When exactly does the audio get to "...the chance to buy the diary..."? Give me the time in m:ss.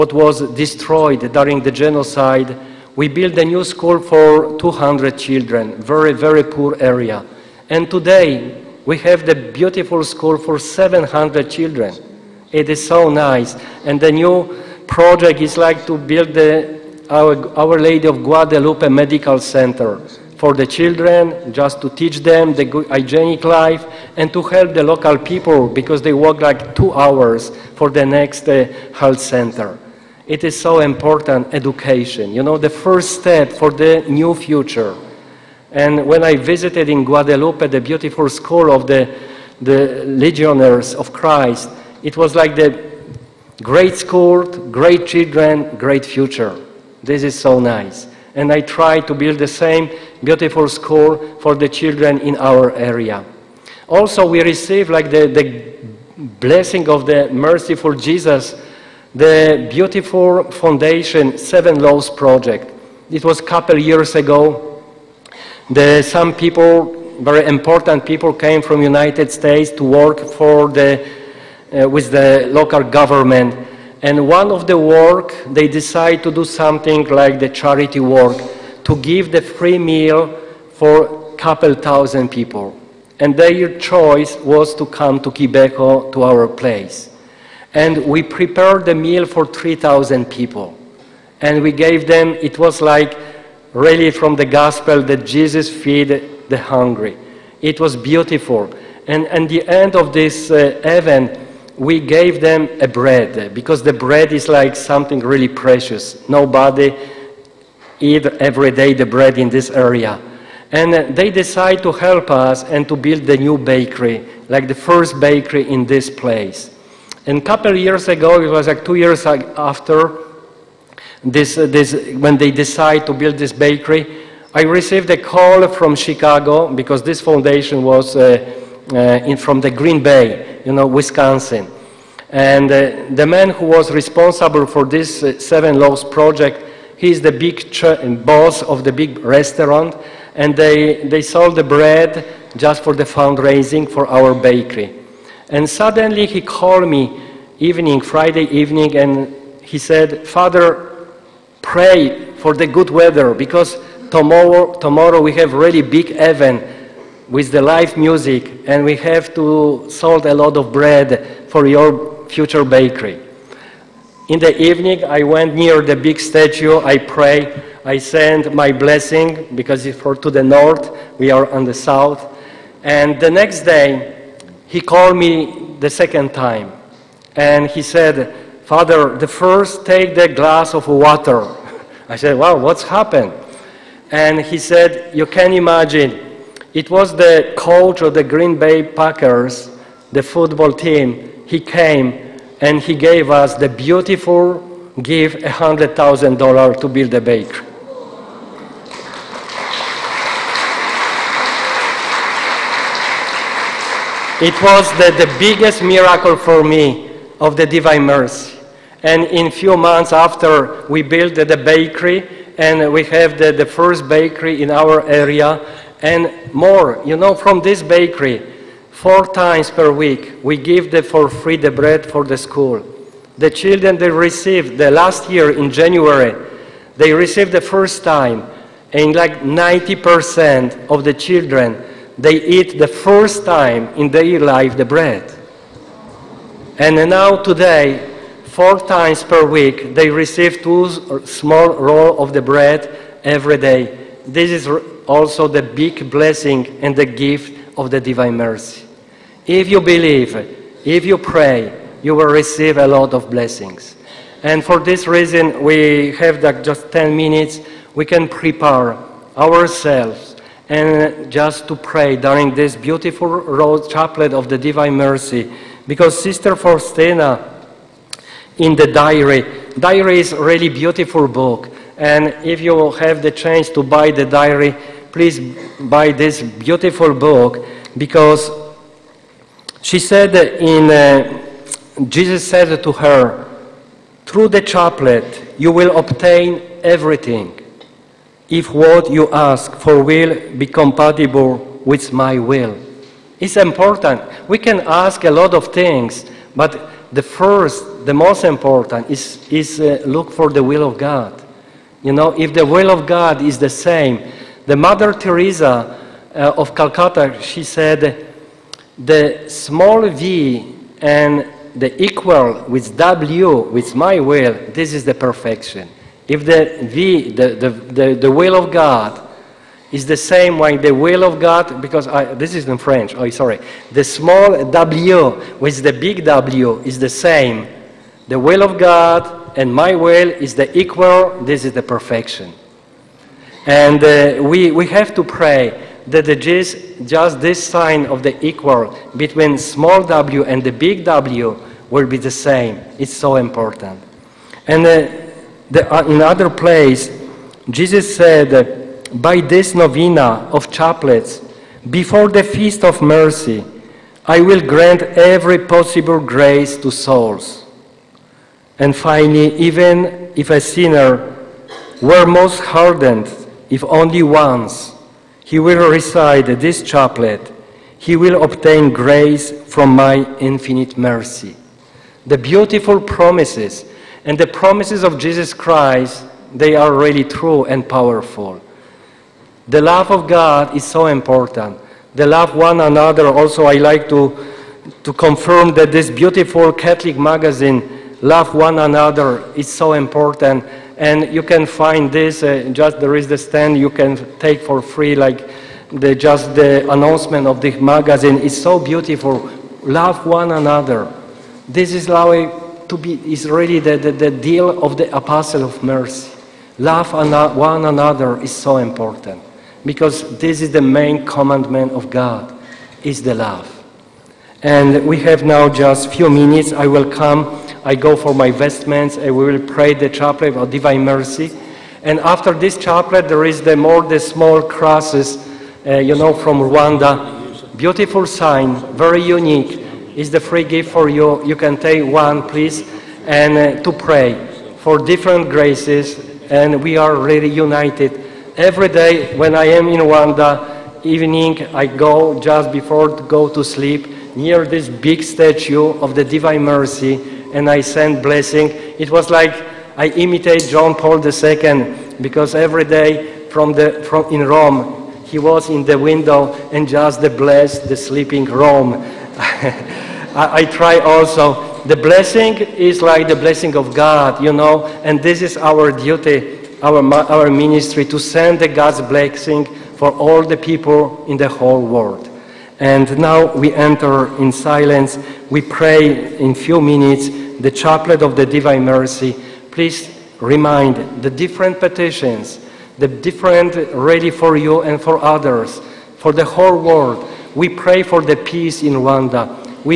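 4:33.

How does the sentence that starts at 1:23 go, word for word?
And their choice was to come to Kibeho, to our place.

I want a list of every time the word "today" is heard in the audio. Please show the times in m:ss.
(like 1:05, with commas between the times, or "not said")
0:07, 3:57.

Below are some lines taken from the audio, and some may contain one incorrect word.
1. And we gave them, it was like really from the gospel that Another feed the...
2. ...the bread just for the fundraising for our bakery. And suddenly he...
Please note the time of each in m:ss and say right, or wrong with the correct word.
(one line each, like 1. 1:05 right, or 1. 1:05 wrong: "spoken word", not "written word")
1. 1:31 wrong: "Jesus", not "Another"
2. 2:21 right.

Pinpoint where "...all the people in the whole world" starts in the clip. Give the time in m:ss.
7:50.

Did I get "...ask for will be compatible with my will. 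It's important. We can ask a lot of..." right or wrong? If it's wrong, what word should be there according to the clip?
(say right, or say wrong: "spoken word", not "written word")
right.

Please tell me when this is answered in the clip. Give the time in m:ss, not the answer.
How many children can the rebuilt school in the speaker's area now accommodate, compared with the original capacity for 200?
0:10.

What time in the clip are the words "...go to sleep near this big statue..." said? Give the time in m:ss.
7:23.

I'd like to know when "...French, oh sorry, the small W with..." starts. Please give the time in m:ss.
5:22.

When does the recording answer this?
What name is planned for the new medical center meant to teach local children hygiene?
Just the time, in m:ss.
0:17.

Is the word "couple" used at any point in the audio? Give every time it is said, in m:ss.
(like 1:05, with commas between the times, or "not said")
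1:03, 1:21, 1:57.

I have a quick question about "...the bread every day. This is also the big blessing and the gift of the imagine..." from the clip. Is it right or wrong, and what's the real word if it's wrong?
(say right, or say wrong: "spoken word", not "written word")
wrong: "divine", not "imagine".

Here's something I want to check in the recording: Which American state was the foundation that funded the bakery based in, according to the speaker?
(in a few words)
Wisconsin.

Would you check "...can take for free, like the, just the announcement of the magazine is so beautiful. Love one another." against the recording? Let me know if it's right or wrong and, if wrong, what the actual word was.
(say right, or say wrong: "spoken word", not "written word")
right.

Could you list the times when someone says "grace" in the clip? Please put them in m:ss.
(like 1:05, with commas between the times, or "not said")
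5:56, 6:08, 7:15.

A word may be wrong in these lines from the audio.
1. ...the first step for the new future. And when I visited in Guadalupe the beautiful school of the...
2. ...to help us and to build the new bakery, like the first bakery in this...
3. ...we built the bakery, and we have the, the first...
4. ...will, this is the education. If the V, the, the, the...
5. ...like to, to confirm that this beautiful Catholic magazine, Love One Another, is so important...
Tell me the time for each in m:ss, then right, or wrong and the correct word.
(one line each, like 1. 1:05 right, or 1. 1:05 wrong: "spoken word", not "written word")
1. 0:32 right
2. 1:51 right
3. 3:30 right
4. 5:14 wrong: "perfection", not "education"
5. 6:23 right.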